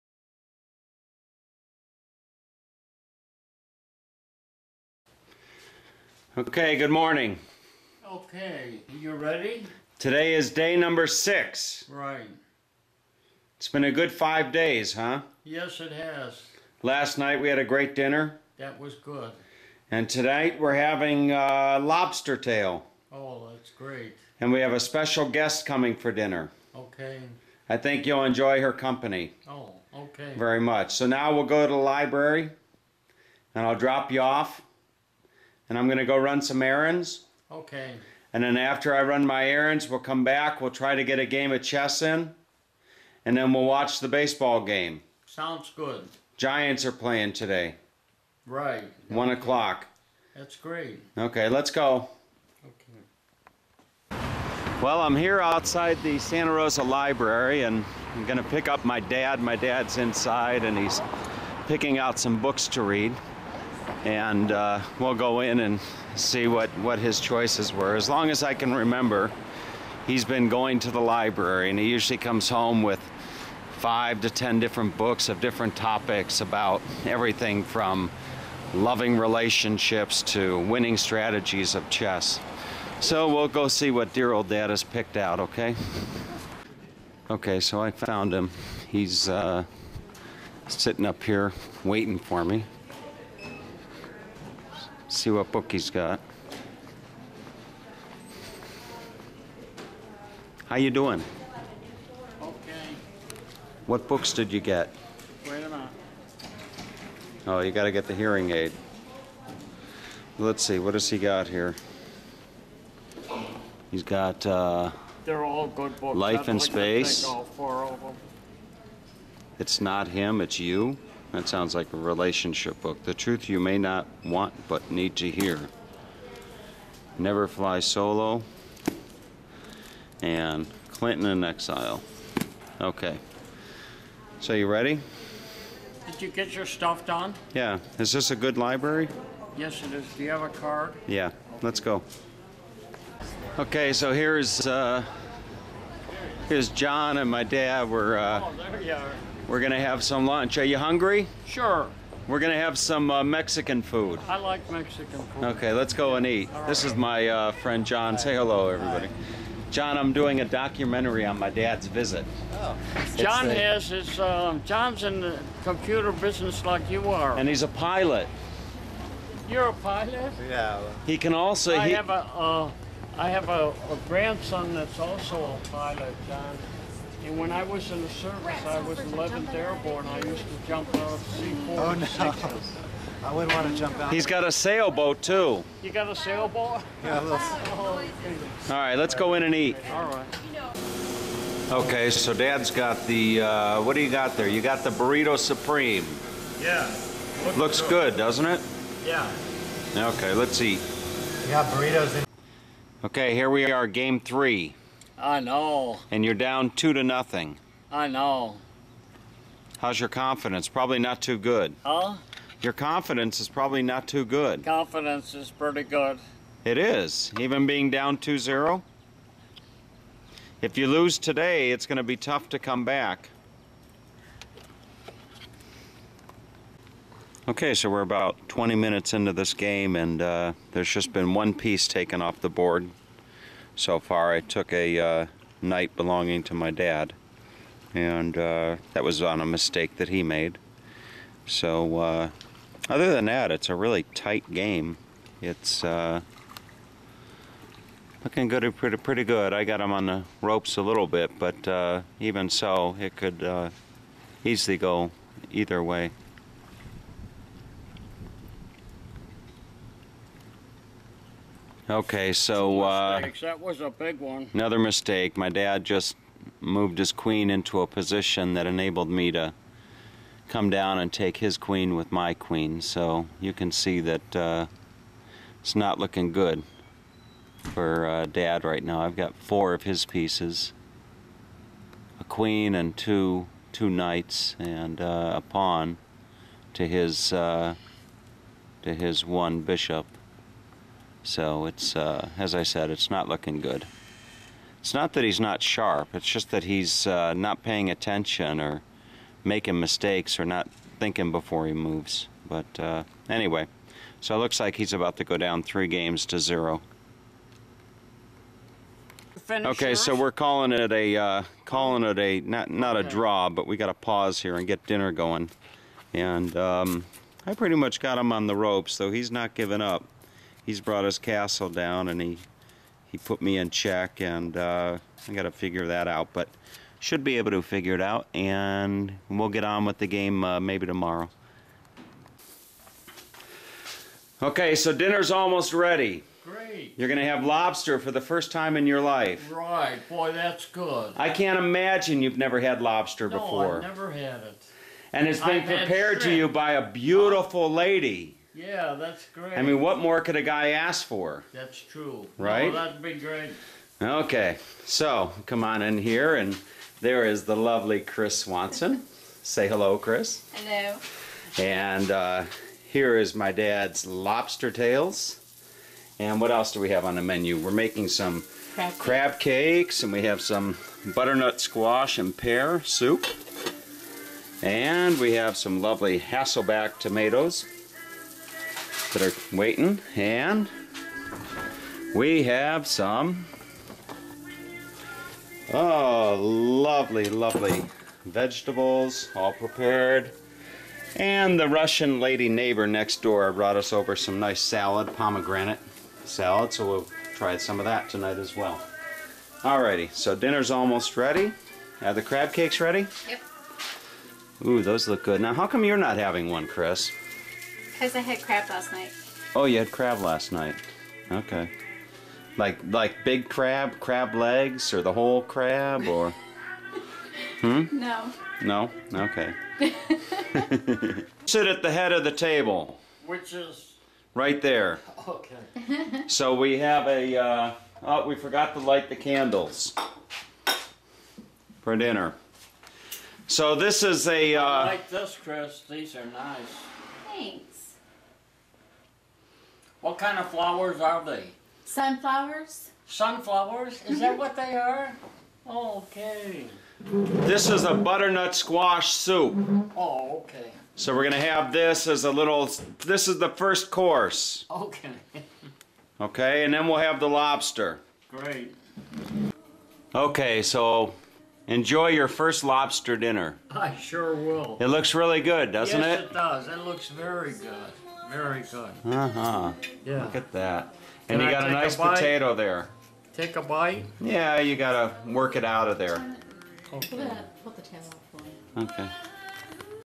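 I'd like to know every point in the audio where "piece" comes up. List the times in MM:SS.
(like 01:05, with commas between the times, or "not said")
03:51, 04:40.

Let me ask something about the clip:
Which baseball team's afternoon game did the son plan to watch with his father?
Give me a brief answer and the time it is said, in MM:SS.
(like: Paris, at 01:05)
Giants, at 00:46.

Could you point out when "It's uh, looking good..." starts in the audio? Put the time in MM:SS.
04:05.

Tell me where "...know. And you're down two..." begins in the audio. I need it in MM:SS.
03:25.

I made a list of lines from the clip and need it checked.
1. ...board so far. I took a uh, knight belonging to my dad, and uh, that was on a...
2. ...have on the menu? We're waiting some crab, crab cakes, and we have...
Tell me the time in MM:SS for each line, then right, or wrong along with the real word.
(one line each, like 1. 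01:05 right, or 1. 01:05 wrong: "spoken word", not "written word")
1. 03:52 right
2. 06:06 wrong: "making", not "waiting".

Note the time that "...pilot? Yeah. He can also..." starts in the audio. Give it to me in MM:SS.
02:49.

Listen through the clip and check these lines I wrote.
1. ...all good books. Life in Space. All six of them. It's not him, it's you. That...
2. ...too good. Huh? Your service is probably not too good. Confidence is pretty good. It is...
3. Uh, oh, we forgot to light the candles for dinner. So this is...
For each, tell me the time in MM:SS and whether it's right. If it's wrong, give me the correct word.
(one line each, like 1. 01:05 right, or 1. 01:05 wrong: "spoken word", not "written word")
1. 01:55 wrong: "four", not "six"
2. 03:31 wrong: "confidence", not "service"
3. 07:07 right.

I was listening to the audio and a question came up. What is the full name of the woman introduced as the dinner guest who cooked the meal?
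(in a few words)
Chris Swanson.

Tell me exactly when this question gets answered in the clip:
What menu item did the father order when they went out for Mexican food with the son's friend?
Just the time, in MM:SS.
03:14.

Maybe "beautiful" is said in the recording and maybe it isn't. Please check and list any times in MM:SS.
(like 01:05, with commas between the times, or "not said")
05:46.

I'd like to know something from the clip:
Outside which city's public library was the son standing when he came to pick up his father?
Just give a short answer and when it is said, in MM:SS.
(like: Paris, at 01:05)
Santa Rosa, at 00:56.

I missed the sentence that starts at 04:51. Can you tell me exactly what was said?
So it's, uh, as I said, it's not looking good.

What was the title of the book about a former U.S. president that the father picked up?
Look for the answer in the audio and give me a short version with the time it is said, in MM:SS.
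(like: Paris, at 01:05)
Clinton in Exile, at 02:10.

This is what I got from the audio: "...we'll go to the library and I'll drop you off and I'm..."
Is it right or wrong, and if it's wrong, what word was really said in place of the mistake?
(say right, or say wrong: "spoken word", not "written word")
right.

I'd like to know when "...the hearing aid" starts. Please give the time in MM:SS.
01:48.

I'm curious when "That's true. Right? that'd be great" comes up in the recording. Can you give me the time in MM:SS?
05:51.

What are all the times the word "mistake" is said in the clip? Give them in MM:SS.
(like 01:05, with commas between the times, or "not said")
03:59, 04:24, 04:59.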